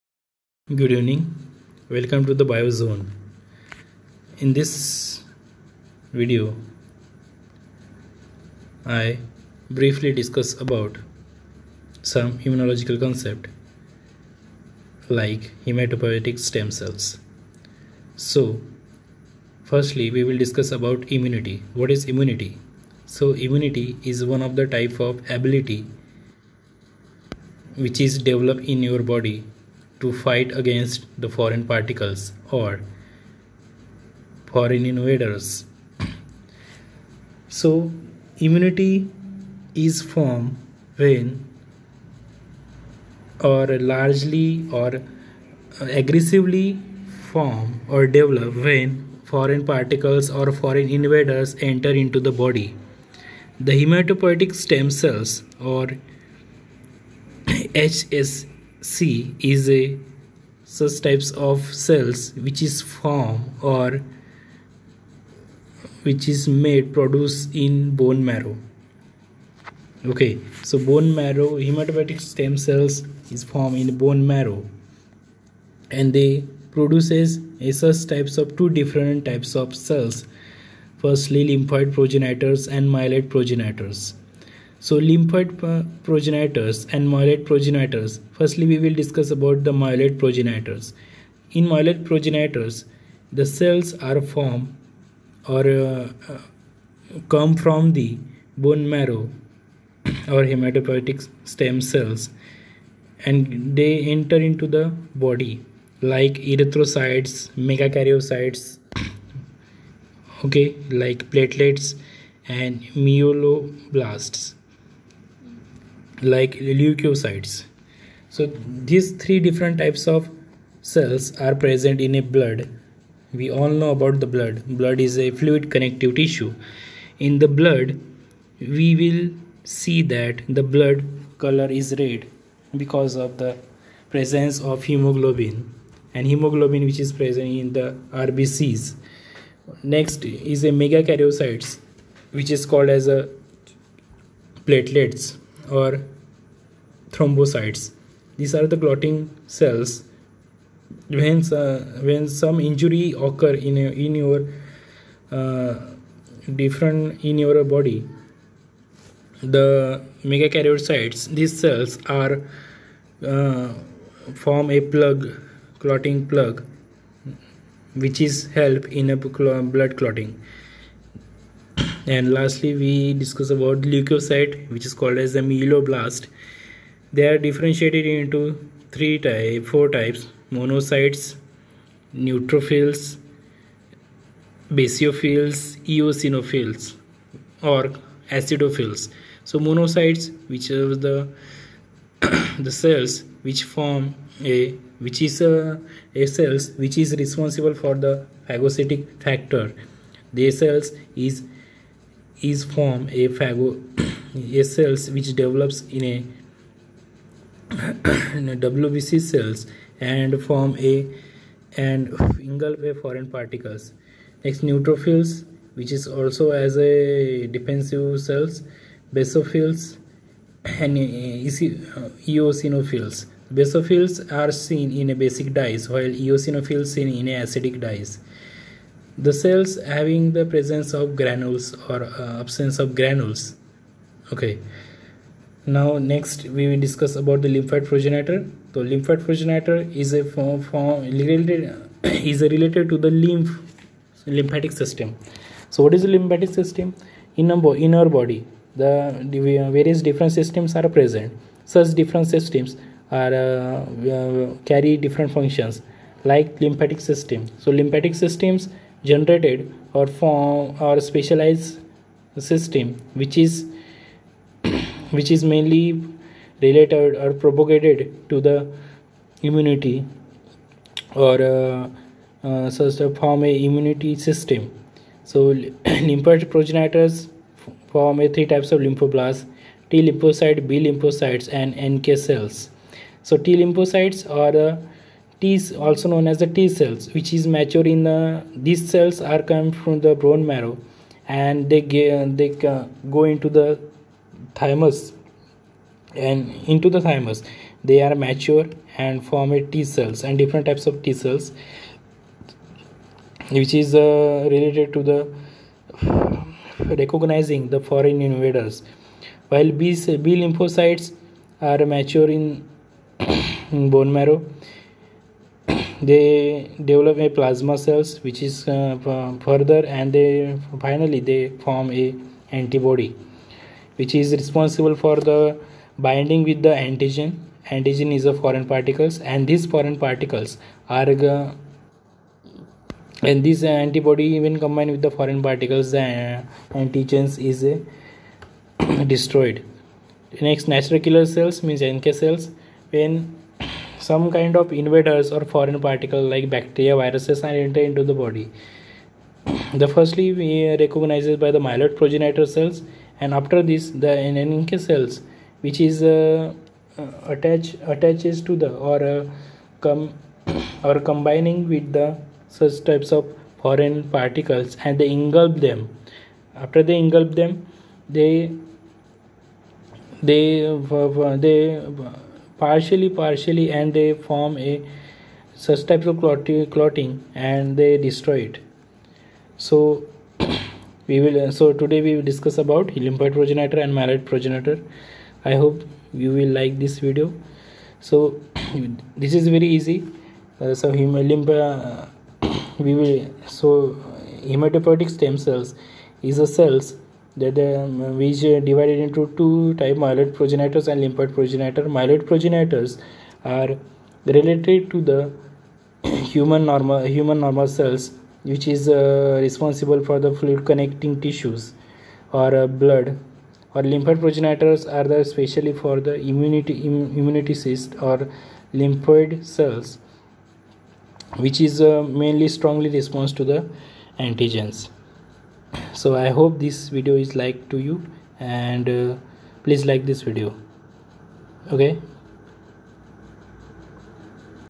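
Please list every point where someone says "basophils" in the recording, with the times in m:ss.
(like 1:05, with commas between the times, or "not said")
3:04, 3:39, 3:43.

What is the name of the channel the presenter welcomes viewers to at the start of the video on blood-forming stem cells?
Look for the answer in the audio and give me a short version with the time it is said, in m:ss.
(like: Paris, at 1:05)
Biozone, at 0:02.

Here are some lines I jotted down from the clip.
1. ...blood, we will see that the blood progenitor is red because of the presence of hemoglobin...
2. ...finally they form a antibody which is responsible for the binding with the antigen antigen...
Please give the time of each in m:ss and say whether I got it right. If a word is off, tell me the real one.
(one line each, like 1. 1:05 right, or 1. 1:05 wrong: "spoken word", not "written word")
1. 2:07 wrong: "color", not "progenitor"
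2. 5:20 right.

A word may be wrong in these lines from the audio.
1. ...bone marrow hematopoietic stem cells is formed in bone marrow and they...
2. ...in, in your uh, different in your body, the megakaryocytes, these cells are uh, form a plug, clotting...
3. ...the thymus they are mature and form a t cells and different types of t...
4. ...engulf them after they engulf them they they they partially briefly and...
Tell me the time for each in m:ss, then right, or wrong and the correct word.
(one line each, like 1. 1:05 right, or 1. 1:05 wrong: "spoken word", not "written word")
1. 1:10 right
2. 2:33 right
3. 4:56 right
4. 6:05 wrong: "partially", not "briefly".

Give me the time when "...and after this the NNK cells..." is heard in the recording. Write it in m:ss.
5:53.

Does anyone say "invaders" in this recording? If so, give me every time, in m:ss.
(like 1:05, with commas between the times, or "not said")
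0:34, 0:50, 5:08, 5:44.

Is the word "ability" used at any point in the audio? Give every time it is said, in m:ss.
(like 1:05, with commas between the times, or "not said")
0:25.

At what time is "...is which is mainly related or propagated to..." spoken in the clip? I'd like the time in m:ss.
4:23.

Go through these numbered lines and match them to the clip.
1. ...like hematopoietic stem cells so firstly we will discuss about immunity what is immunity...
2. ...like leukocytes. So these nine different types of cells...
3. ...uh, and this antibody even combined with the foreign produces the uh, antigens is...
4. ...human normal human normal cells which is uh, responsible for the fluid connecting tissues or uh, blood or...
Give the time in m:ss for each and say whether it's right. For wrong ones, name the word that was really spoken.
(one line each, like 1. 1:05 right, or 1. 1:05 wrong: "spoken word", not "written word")
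1. 0:15 right
2. 1:56 wrong: "three", not "nine"
3. 5:31 wrong: "particles", not "produces"
4. 6:46 right.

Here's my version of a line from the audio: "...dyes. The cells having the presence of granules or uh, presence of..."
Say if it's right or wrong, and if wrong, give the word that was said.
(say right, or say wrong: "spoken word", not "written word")
wrong: "absence", not "presence".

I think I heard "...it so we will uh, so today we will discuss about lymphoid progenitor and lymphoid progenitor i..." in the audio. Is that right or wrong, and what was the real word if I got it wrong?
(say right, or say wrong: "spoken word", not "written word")
wrong: "myeloid", not "lymphoid".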